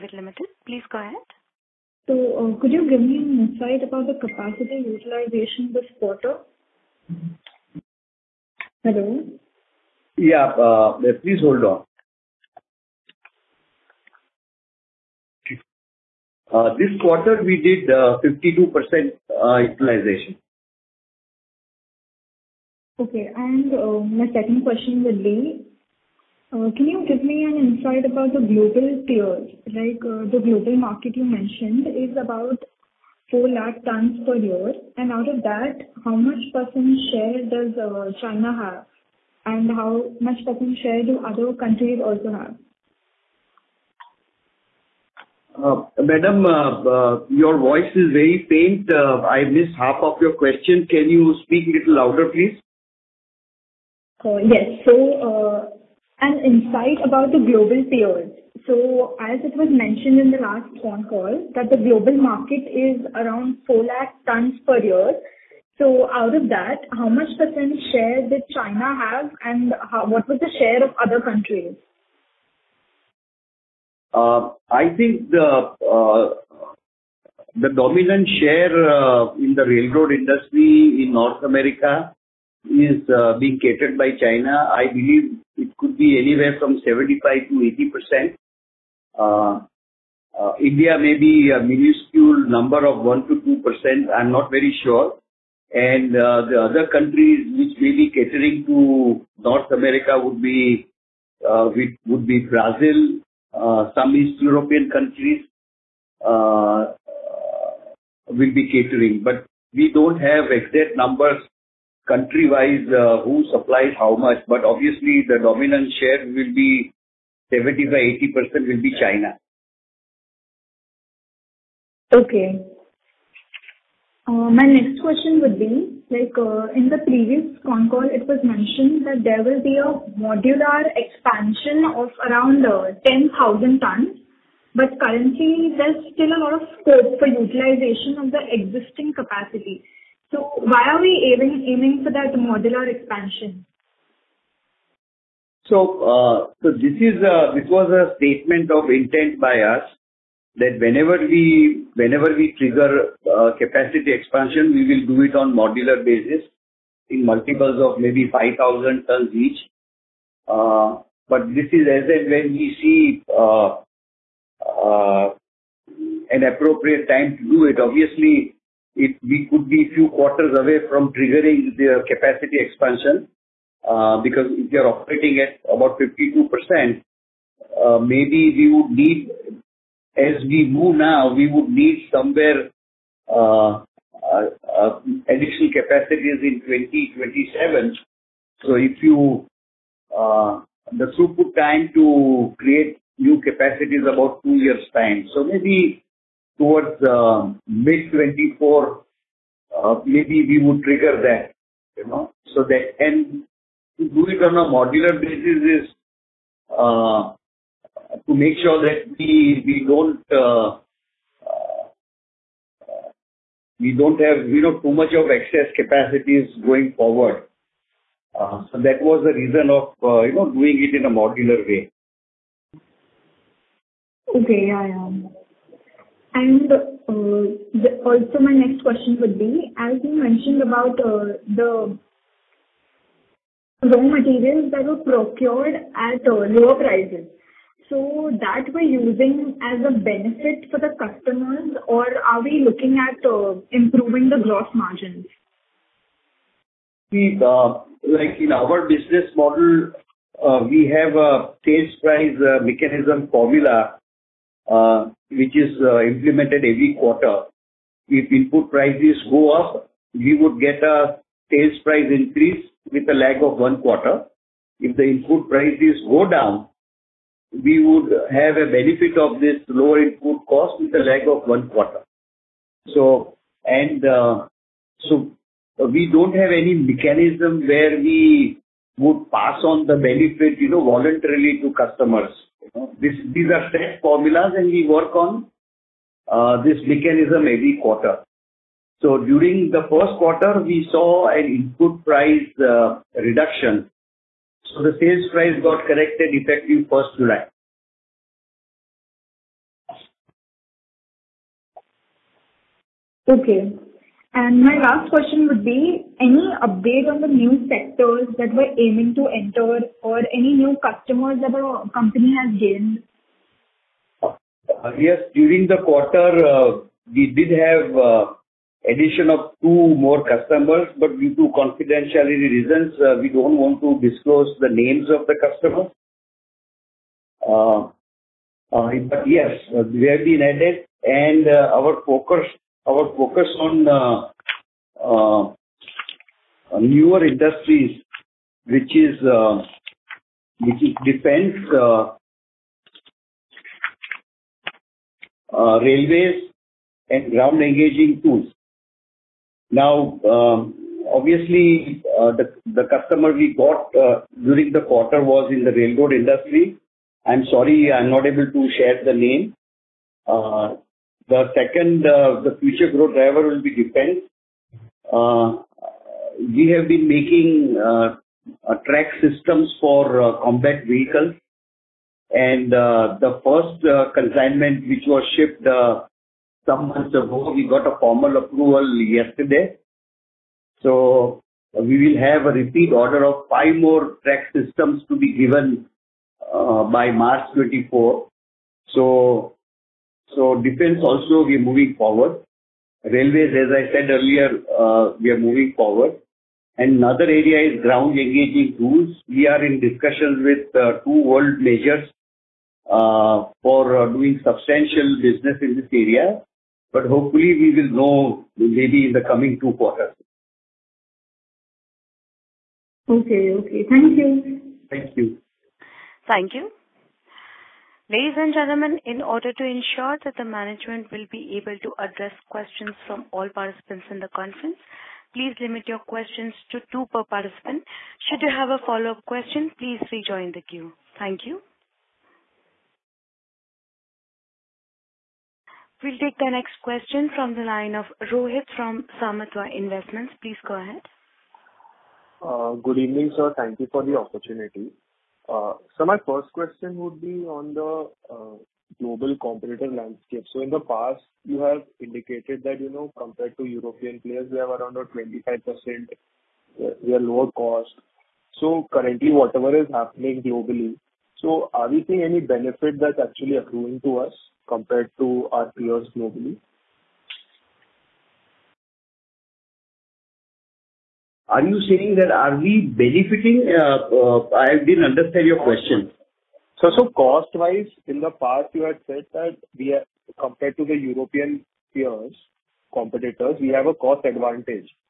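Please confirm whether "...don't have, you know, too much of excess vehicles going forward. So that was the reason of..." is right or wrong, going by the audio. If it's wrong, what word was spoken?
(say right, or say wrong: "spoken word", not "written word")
wrong: "capacities", not "vehicles".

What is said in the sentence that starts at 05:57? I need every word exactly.
I'm sorry, I'm not able to share the name.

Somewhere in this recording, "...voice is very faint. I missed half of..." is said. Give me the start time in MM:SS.
00:47.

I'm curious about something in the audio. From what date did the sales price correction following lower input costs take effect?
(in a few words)
1st July.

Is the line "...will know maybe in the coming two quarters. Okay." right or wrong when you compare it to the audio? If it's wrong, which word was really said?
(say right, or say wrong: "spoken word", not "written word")
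right.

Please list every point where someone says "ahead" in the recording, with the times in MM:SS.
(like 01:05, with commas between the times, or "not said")
00:00, 07:20.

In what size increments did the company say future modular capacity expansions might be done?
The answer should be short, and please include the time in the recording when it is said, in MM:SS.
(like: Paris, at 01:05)
5,000 tons, at 02:38.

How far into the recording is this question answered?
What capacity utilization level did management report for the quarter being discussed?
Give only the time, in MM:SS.
00:17.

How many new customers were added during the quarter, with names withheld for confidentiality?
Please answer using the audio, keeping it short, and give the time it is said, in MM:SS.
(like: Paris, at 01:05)
2, at 05:19.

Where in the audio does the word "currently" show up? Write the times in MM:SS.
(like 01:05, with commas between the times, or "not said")
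02:14, 07:38.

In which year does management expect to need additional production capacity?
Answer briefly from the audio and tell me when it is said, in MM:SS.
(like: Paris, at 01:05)
2027, at 03:06.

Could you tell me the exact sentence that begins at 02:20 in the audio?
So why are we aiming for that modular expansion?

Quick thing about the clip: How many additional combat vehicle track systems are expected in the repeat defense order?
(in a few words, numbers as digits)
5.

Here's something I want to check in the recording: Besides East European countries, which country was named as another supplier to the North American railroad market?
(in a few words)
Brazil.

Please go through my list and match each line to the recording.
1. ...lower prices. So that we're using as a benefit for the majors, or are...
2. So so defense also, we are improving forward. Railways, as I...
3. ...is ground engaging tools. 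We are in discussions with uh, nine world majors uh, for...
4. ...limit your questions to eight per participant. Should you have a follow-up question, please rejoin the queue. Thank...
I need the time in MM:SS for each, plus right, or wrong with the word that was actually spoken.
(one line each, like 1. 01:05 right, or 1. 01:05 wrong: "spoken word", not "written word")
1. 03:56 wrong: "customers", not "majors"
2. 06:28 wrong: "moving", not "improving"
3. 06:37 wrong: "two", not "nine"
4. 07:05 wrong: "two", not "eight".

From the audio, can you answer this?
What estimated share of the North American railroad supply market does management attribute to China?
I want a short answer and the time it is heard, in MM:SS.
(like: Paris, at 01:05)
75 to 80 percent, at 01:26.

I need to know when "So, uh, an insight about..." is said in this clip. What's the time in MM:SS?
00:54.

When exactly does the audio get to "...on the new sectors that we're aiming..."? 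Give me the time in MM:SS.
05:07.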